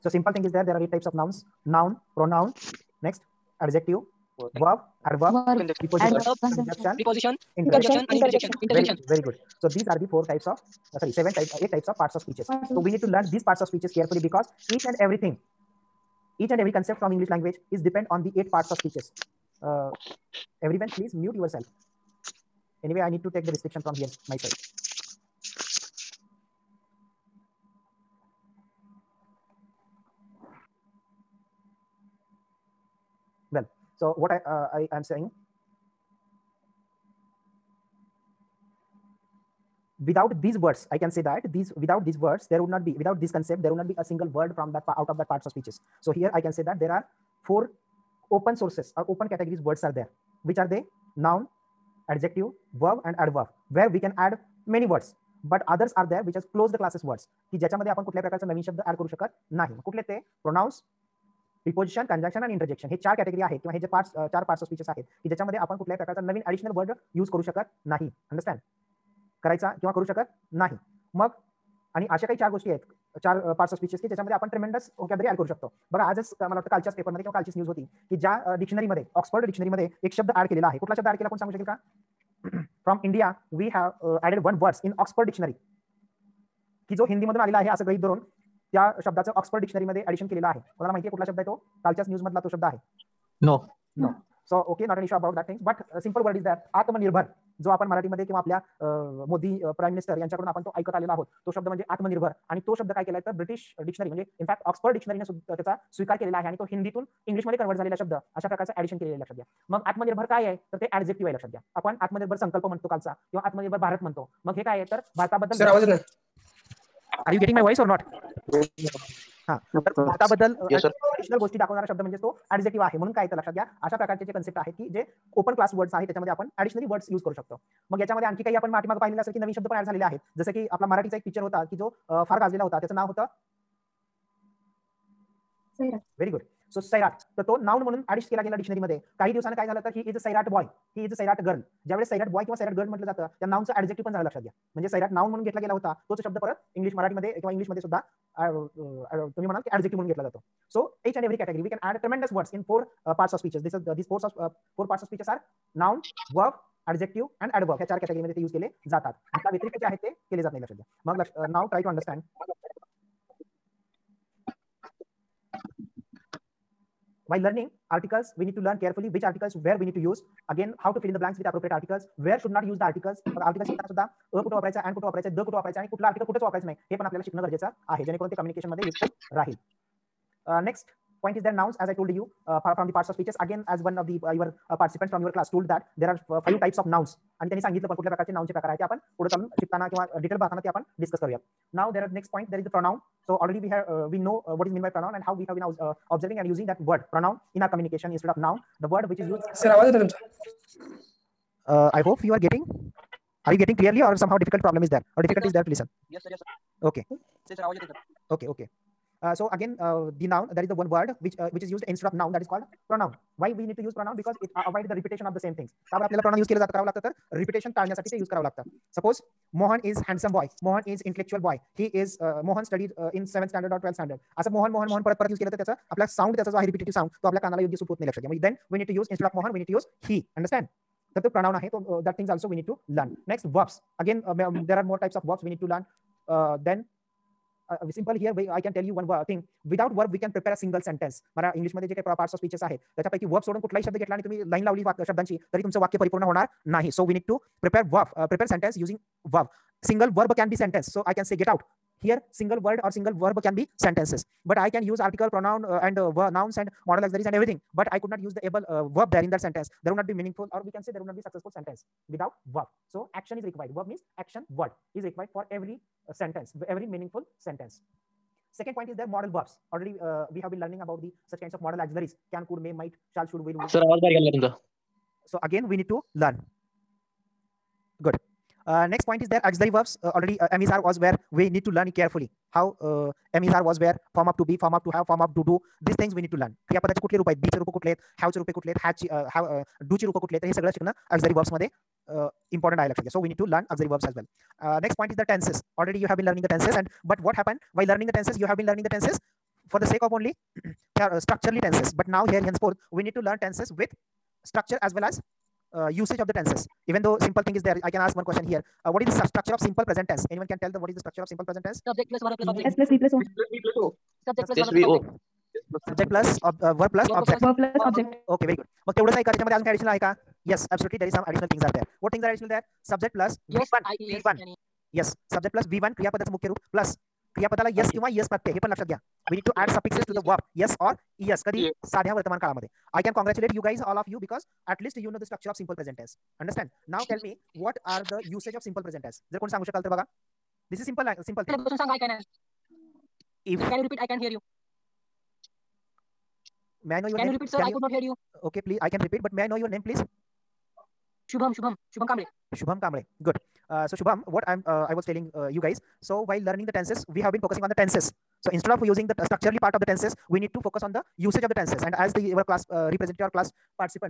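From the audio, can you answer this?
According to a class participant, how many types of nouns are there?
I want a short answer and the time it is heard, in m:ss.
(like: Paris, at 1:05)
5, at 3:06.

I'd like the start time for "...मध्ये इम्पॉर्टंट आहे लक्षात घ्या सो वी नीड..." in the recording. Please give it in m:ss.
4:51.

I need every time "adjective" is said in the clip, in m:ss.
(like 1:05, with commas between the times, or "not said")
0:03, 0:52.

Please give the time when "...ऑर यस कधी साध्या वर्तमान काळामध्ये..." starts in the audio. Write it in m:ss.
5:30.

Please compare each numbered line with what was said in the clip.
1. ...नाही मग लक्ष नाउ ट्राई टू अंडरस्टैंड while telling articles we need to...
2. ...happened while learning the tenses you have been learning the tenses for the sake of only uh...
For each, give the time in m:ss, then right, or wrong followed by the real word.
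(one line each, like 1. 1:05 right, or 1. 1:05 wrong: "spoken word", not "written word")
1. 2:40 wrong: "learning", not "telling"
2. 4:57 right.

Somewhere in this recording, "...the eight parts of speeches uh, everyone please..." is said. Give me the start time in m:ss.
0:18.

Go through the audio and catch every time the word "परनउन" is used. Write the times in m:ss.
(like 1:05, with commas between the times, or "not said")
3:36, 3:51.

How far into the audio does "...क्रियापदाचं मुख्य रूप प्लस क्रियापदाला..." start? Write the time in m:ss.
5:25.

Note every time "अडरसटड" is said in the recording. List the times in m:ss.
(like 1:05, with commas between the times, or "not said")
1:08, 2:41, 3:50.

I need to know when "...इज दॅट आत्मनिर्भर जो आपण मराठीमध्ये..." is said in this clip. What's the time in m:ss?
1:36.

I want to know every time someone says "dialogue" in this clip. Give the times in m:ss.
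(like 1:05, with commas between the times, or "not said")
not said.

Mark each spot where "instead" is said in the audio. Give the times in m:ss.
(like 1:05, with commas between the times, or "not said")
3:31, 5:58.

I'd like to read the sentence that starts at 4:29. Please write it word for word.
Already uh, we have been learning about the such kinds of modal auxiliaries.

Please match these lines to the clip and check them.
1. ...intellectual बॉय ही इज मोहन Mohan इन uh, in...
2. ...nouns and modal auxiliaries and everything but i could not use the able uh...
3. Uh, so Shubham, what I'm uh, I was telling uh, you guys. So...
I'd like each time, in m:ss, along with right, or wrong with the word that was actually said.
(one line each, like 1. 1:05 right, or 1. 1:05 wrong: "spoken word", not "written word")
1. 3:41 right
2. 4:16 right
3. 5:53 right.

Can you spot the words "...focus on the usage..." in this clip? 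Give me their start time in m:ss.
6:00.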